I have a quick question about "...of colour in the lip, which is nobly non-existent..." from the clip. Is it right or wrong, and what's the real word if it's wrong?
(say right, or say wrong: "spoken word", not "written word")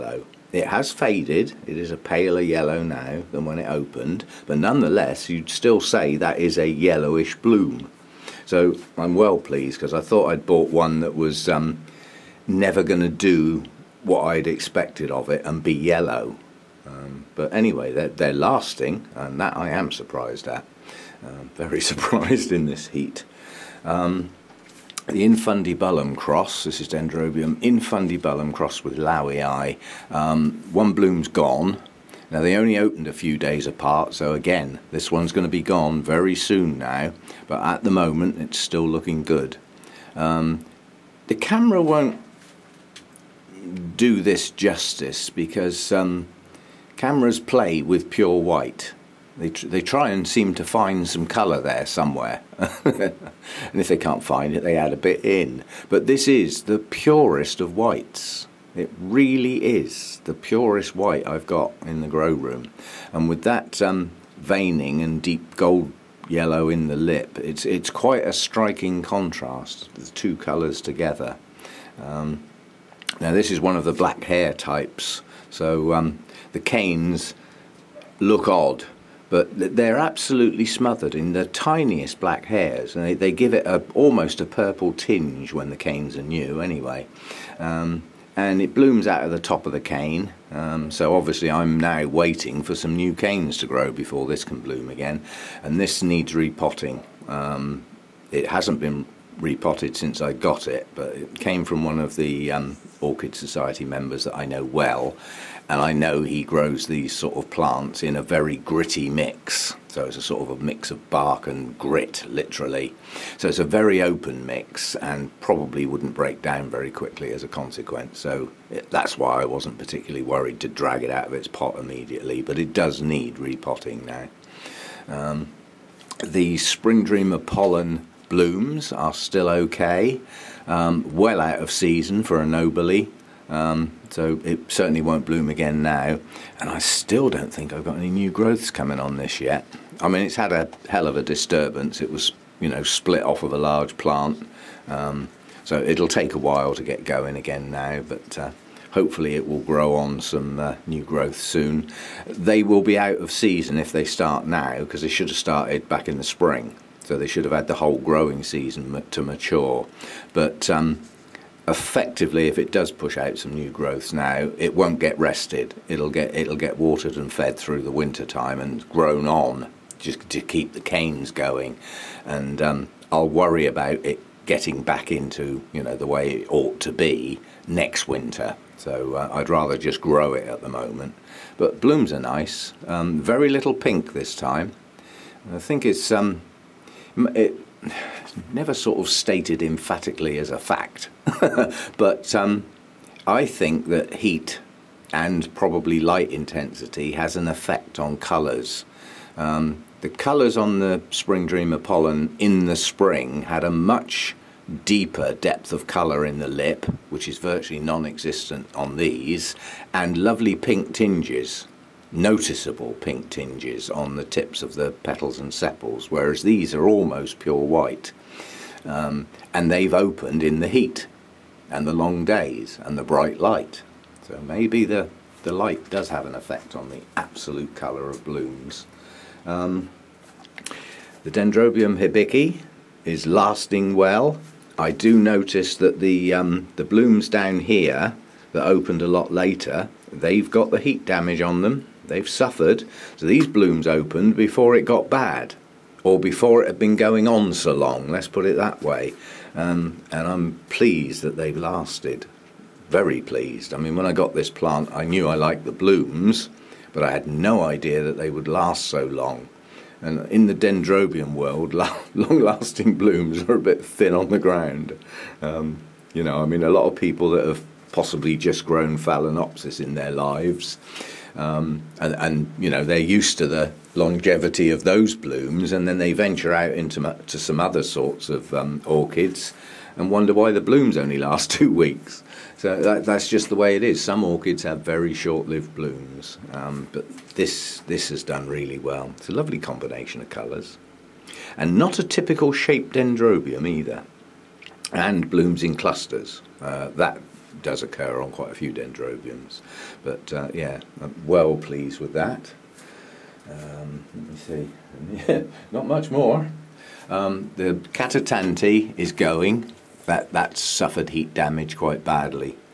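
wrong: "virtually", not "nobly".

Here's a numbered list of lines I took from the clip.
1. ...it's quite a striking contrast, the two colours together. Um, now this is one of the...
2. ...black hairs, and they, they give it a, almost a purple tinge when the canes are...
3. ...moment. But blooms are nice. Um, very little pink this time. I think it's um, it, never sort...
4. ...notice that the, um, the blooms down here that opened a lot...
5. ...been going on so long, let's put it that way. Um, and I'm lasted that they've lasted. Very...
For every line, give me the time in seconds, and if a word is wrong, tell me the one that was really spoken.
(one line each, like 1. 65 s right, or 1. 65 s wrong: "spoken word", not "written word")
1. 67 s right
2. 82 s right
3. 180 s right
4. 235 s right
5. 246 s wrong: "pleased", not "lasted".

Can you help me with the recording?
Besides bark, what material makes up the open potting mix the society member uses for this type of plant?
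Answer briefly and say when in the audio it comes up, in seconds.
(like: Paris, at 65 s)
grit, at 111 s.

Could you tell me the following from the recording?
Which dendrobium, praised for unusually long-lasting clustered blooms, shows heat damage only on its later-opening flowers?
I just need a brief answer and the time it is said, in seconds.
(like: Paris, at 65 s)
Dendrobium hibiki, at 231 s.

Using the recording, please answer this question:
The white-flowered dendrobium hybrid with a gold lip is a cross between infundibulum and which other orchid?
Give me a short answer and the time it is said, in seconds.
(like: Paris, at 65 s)
Lowii, at 28 s.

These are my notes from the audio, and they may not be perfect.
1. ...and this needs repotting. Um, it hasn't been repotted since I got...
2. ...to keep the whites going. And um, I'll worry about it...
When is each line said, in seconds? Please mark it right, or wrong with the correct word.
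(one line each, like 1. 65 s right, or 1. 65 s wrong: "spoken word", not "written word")
1. 95 s right
2. 170 s wrong: "canes", not "whites".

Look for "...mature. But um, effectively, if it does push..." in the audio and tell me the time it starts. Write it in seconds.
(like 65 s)
159 s.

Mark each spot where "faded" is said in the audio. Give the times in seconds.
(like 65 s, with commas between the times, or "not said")
0 s.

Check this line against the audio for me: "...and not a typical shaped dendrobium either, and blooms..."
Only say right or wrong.
right.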